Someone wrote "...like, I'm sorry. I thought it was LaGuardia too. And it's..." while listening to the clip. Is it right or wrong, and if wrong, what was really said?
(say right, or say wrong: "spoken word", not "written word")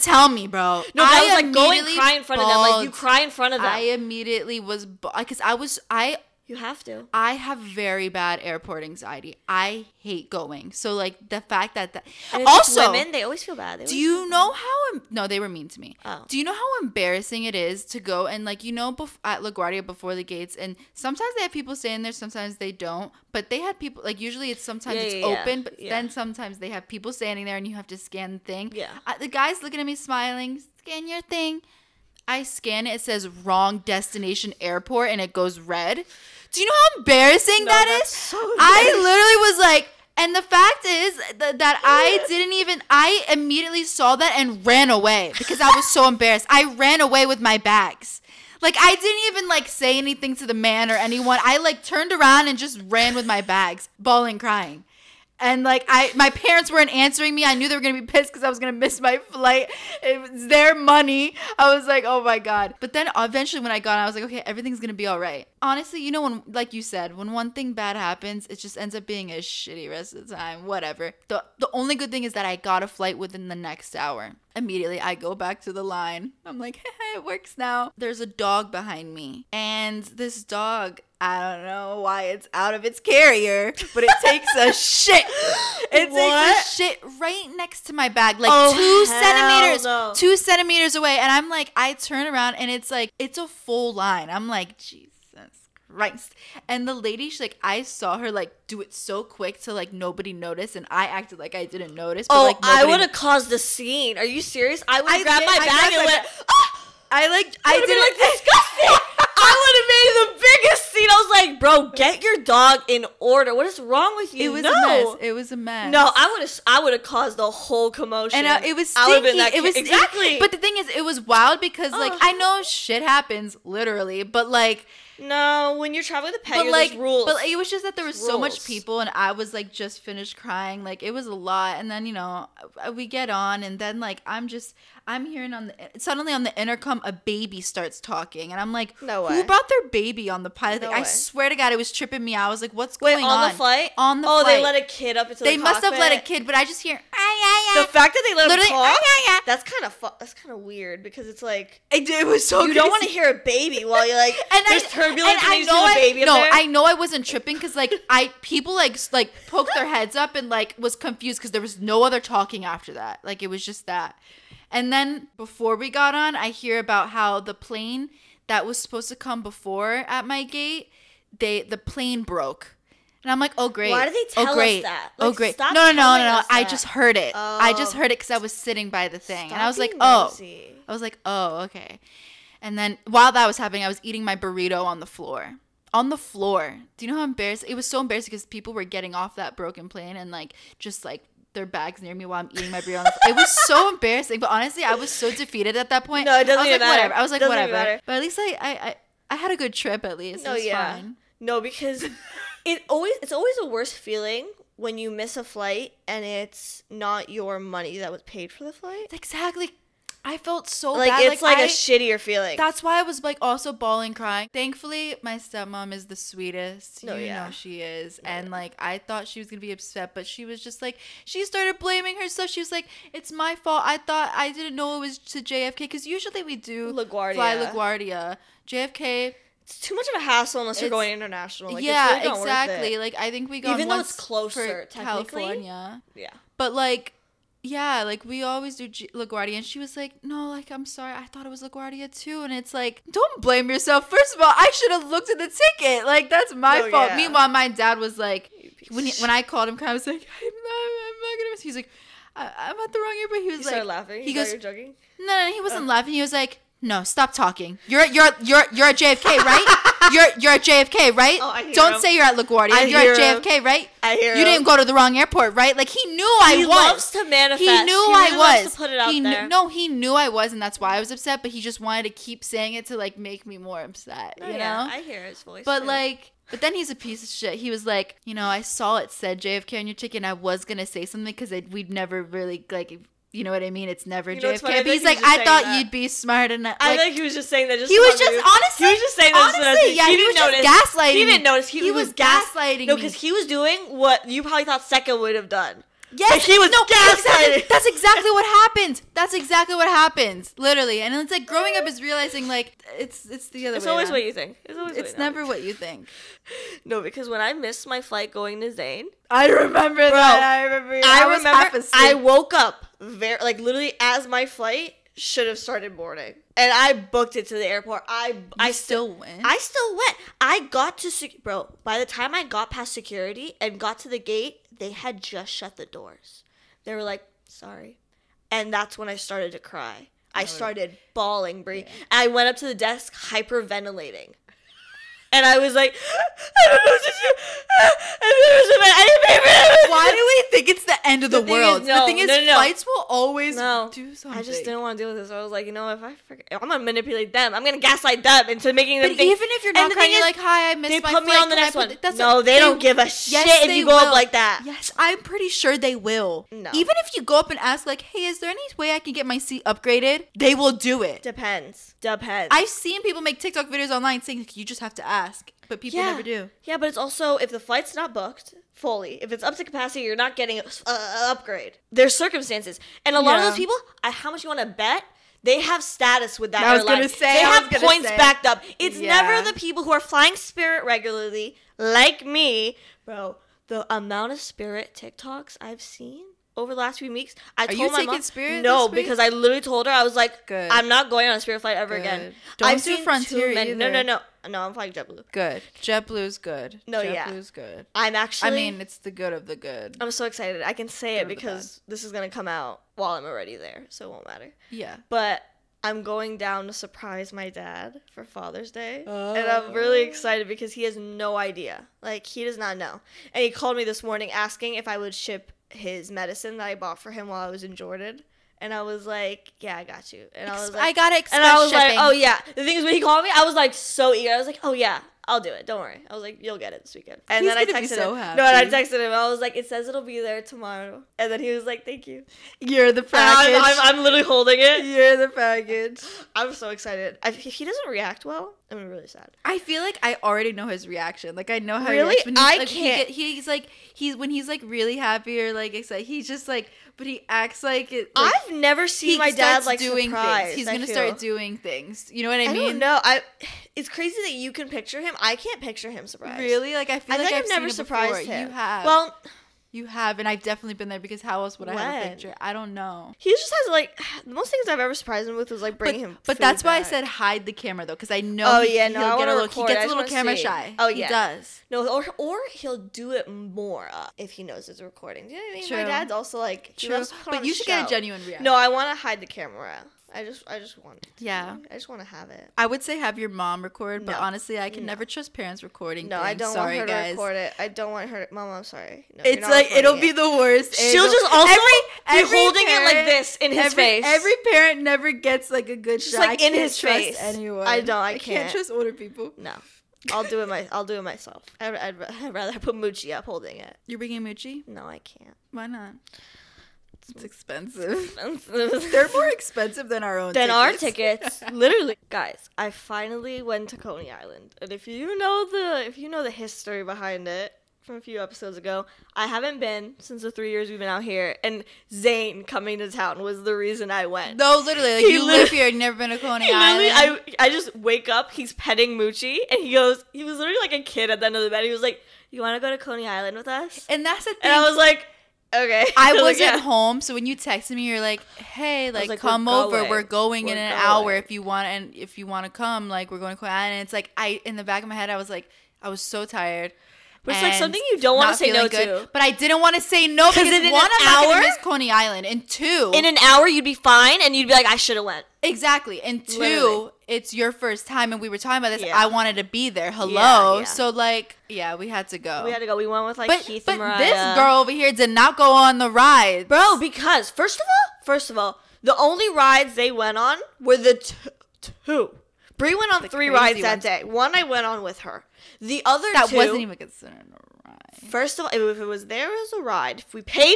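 right.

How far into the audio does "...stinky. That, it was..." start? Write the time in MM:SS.
01:58.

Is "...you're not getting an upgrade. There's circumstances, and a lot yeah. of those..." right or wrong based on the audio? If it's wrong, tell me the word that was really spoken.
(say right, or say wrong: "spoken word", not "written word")
right.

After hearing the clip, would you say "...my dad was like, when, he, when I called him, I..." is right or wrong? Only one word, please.
right.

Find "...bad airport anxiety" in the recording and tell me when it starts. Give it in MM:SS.
00:08.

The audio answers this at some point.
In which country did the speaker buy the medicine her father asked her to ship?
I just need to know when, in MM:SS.
06:57.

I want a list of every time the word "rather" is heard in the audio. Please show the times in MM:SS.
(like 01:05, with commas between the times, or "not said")
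08:22.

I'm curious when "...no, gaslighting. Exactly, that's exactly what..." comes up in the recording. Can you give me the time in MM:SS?
04:56.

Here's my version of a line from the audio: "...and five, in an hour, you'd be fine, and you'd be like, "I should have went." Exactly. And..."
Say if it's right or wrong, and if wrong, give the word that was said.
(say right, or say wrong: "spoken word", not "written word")
wrong: "two", not "five".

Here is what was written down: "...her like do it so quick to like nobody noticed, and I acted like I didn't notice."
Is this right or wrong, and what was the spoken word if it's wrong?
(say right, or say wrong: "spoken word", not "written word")
right.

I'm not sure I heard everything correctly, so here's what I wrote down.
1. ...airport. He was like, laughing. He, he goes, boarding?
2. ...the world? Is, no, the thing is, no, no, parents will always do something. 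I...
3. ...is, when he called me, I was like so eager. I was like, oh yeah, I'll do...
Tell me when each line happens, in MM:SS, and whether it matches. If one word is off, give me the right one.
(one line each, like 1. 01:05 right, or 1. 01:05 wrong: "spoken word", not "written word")
1. 04:13 wrong: "joking", not "boarding"
2. 05:41 wrong: "fights", not "parents"
3. 07:02 right.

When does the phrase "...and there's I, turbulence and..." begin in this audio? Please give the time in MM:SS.
02:34.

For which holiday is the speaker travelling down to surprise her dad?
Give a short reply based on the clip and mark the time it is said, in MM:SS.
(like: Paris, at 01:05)
Father's Day, at 06:48.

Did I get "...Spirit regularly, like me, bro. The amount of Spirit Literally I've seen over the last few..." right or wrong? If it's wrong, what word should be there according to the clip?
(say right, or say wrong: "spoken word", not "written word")
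wrong: "TikToks", not "Literally".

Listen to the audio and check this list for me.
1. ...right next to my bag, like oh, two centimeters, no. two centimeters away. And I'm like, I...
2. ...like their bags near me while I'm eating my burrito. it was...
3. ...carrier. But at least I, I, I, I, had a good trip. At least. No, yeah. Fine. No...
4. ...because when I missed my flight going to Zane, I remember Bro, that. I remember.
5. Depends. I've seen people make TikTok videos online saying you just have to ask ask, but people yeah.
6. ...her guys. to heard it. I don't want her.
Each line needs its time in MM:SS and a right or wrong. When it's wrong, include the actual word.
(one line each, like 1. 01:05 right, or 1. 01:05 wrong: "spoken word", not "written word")
1. 01:27 right
2. 03:11 right
3. 03:17 wrong: "whatever", not "carrier"
4. 05:07 right
5. 06:02 right
6. 08:06 wrong: "record", not "heard".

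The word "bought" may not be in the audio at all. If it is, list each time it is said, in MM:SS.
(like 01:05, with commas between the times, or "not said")
06:56.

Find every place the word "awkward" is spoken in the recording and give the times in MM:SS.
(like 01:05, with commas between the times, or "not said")
not said.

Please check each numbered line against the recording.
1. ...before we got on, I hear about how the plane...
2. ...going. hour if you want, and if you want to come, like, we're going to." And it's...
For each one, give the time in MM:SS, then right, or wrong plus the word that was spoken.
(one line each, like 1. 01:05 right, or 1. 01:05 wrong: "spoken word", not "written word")
1. 02:45 right
2. 09:00 right.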